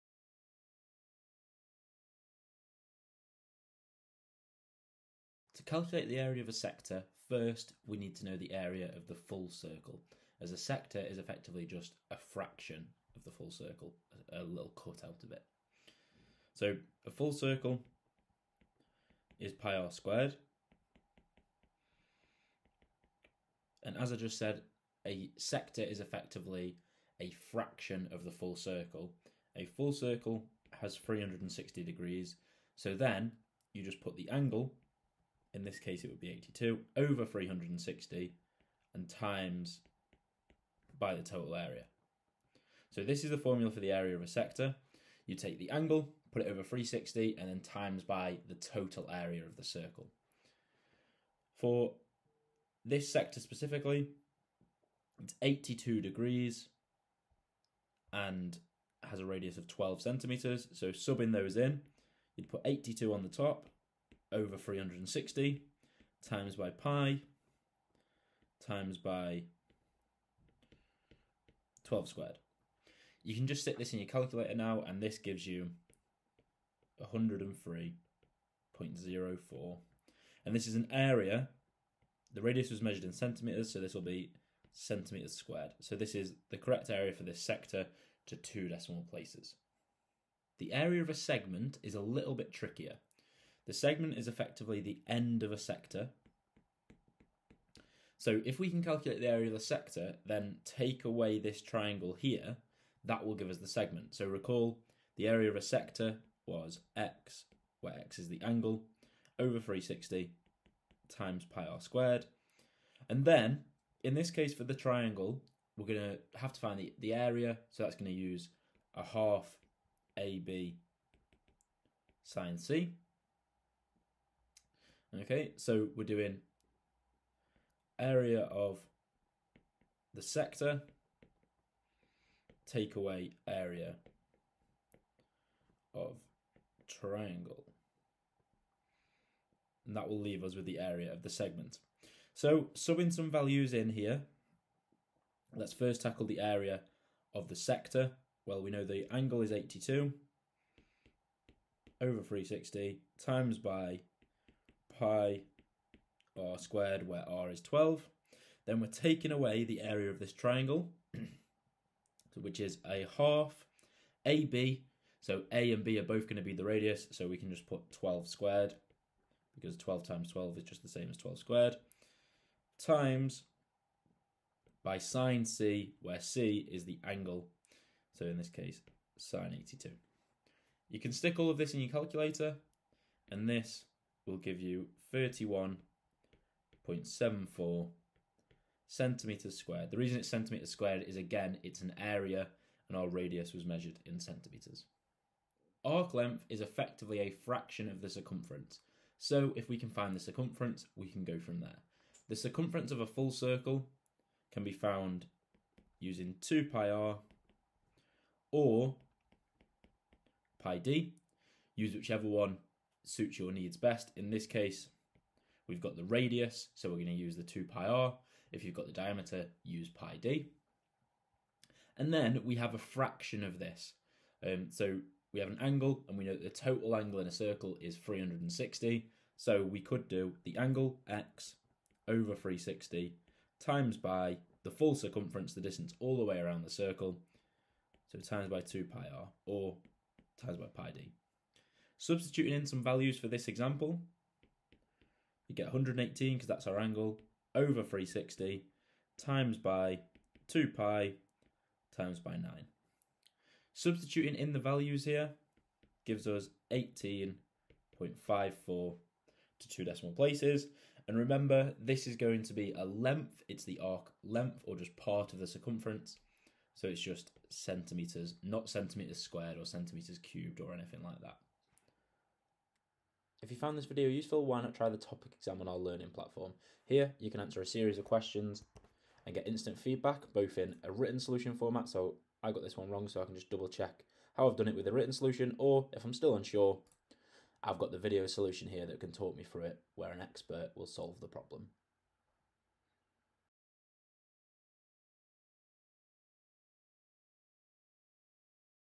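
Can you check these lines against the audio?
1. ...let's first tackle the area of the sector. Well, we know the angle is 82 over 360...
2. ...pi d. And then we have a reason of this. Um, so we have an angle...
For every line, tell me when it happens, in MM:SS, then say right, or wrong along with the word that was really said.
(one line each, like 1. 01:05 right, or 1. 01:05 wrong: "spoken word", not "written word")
1. 02:25 right
2. 03:39 wrong: "fraction", not "reason".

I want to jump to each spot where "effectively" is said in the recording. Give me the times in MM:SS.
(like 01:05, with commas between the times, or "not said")
00:11, 00:25, 01:34, 03:16.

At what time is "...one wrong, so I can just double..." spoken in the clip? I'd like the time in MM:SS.
04:42.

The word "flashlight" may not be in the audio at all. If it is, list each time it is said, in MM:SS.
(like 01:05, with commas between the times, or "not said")
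not said.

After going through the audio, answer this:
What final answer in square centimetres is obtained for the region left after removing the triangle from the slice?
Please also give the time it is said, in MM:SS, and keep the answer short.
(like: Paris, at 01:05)
31.74, at 03:05.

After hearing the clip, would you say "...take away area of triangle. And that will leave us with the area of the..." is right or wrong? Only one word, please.
right.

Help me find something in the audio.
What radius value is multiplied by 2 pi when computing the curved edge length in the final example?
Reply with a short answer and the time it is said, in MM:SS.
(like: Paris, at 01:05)
9, at 04:12.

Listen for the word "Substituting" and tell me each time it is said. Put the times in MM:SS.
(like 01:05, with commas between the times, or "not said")
04:02, 04:13.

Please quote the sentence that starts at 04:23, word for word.
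It's the arc length or just part of the circumference.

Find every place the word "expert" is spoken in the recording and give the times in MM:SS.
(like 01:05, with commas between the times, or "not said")
04:50.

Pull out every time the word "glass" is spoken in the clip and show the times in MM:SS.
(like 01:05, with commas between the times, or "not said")
not said.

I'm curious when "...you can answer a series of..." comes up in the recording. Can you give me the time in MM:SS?
04:37.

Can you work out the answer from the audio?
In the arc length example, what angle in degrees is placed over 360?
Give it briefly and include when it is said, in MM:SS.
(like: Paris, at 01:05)
118, at 04:05.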